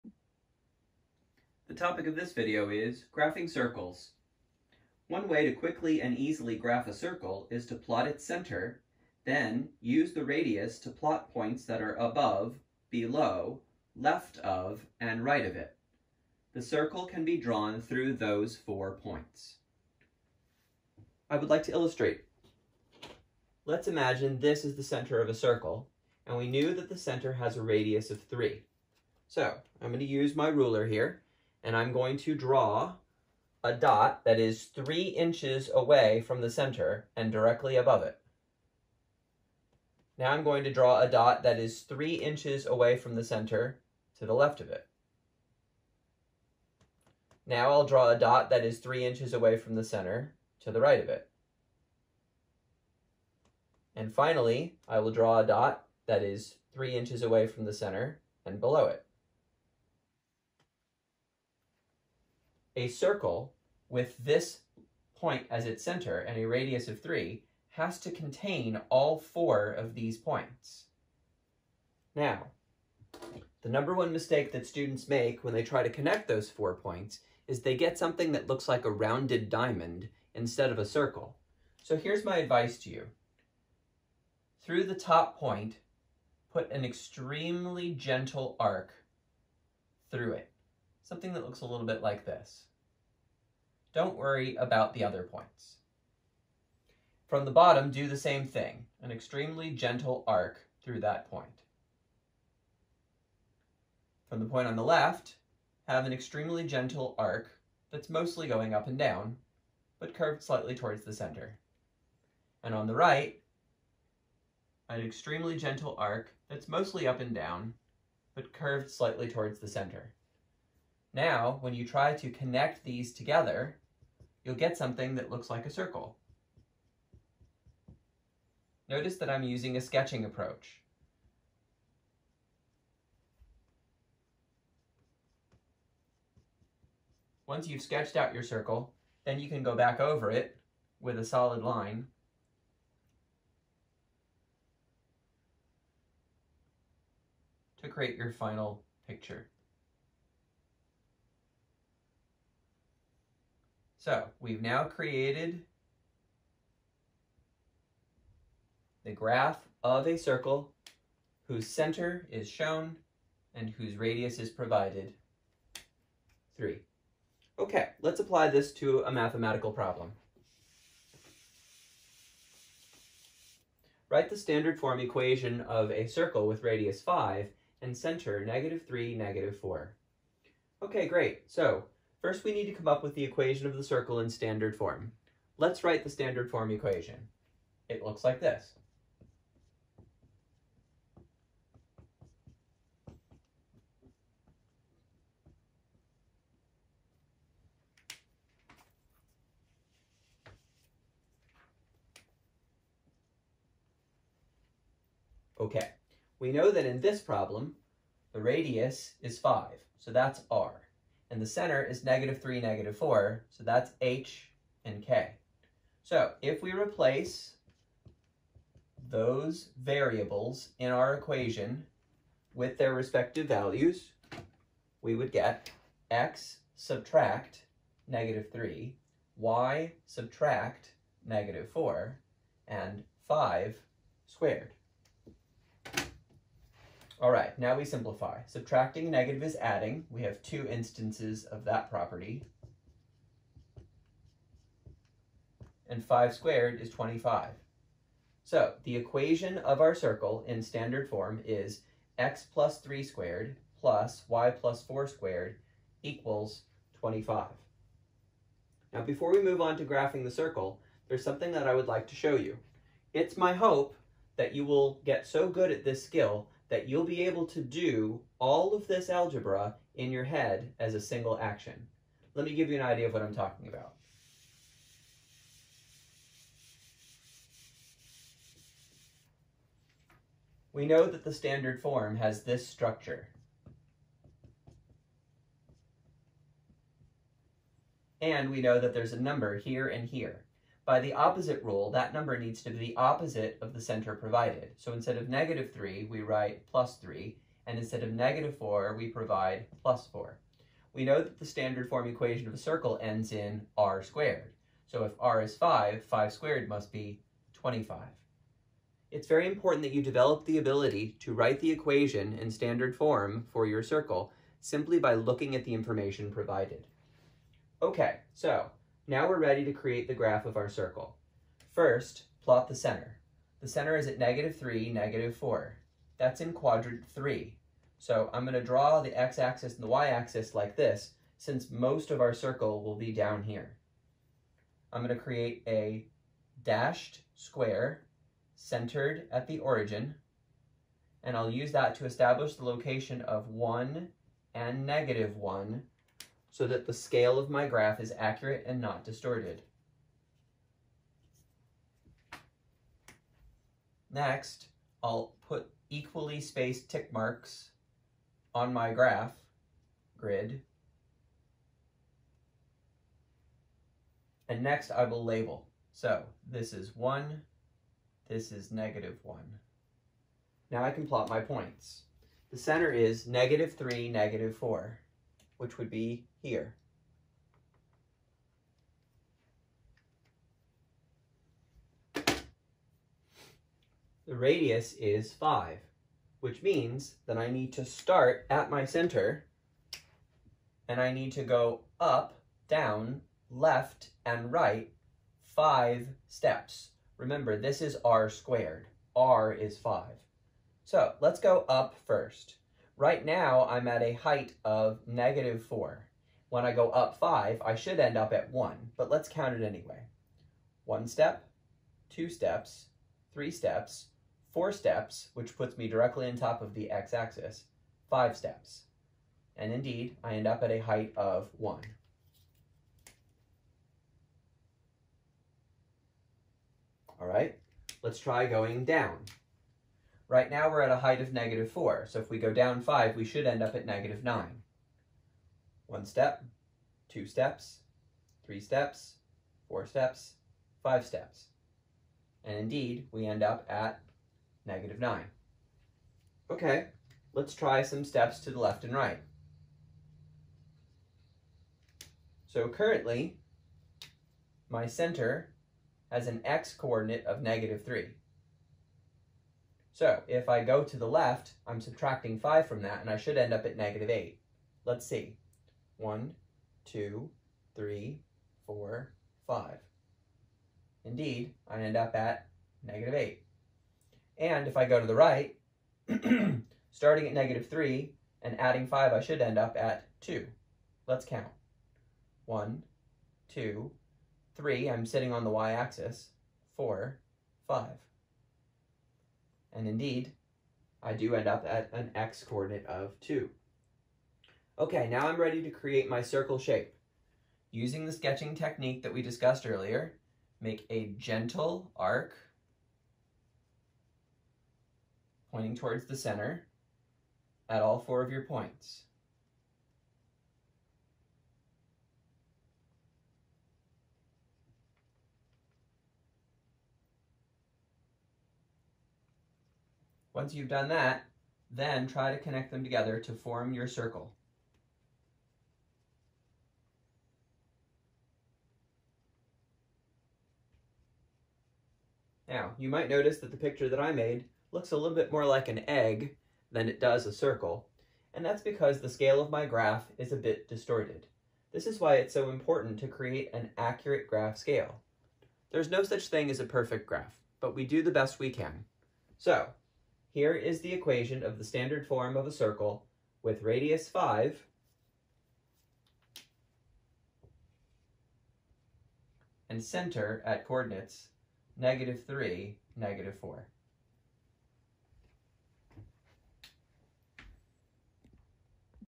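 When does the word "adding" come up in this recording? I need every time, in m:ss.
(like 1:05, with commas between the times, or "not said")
3:59, 7:58.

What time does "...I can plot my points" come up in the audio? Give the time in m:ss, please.
6:10.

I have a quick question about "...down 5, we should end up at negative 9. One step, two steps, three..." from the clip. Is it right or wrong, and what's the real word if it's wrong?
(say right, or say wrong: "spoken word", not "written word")
right.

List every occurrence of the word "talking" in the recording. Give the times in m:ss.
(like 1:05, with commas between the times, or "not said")
4:33.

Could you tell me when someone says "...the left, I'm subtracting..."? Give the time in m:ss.
7:40.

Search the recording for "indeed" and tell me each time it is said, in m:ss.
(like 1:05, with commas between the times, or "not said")
6:59, 7:22, 7:51, 8:09.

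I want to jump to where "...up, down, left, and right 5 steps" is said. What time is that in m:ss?
6:31.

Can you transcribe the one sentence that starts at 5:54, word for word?
Next, I'll put equally spaced tick marks on my graph grid.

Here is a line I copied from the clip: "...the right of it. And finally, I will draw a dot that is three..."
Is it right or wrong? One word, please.
right.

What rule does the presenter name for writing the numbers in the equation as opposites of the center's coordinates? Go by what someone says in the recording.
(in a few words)
opposite rule.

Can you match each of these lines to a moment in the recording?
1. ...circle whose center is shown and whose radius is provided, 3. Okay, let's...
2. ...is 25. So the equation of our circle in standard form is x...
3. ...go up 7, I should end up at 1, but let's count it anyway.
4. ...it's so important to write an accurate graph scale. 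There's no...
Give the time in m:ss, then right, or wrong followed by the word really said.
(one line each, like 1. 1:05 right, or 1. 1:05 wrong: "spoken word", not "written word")
1. 2:40 right
2. 4:06 right
3. 6:46 wrong: "5", not "7"
4. 9:02 wrong: "create", not "write".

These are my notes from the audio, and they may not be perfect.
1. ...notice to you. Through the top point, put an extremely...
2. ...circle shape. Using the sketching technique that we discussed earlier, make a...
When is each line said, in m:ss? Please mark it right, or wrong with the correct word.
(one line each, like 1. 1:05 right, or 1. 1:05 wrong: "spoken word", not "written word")
1. 1:22 wrong: "advice", not "notice"
2. 8:16 right.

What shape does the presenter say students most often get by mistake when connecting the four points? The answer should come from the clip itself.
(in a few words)
rounded diamond.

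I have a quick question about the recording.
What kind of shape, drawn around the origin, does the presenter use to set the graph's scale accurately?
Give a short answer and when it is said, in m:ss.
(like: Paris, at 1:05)
dashed square, at 5:36.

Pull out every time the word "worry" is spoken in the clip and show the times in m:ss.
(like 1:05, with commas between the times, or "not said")
1:34.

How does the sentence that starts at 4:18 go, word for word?
Now before we move on to graphing the circle, there's something that I would like to show you.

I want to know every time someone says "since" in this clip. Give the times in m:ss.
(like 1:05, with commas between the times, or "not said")
5:31.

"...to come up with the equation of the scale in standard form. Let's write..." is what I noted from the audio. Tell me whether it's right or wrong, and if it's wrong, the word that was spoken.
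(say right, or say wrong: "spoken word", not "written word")
wrong: "circle", not "scale".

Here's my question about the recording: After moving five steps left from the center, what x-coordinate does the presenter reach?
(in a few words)
-8.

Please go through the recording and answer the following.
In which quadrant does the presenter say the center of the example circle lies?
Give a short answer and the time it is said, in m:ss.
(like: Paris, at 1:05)
quadrant 3, at 5:26.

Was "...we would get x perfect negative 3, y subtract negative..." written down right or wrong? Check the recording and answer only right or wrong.
wrong.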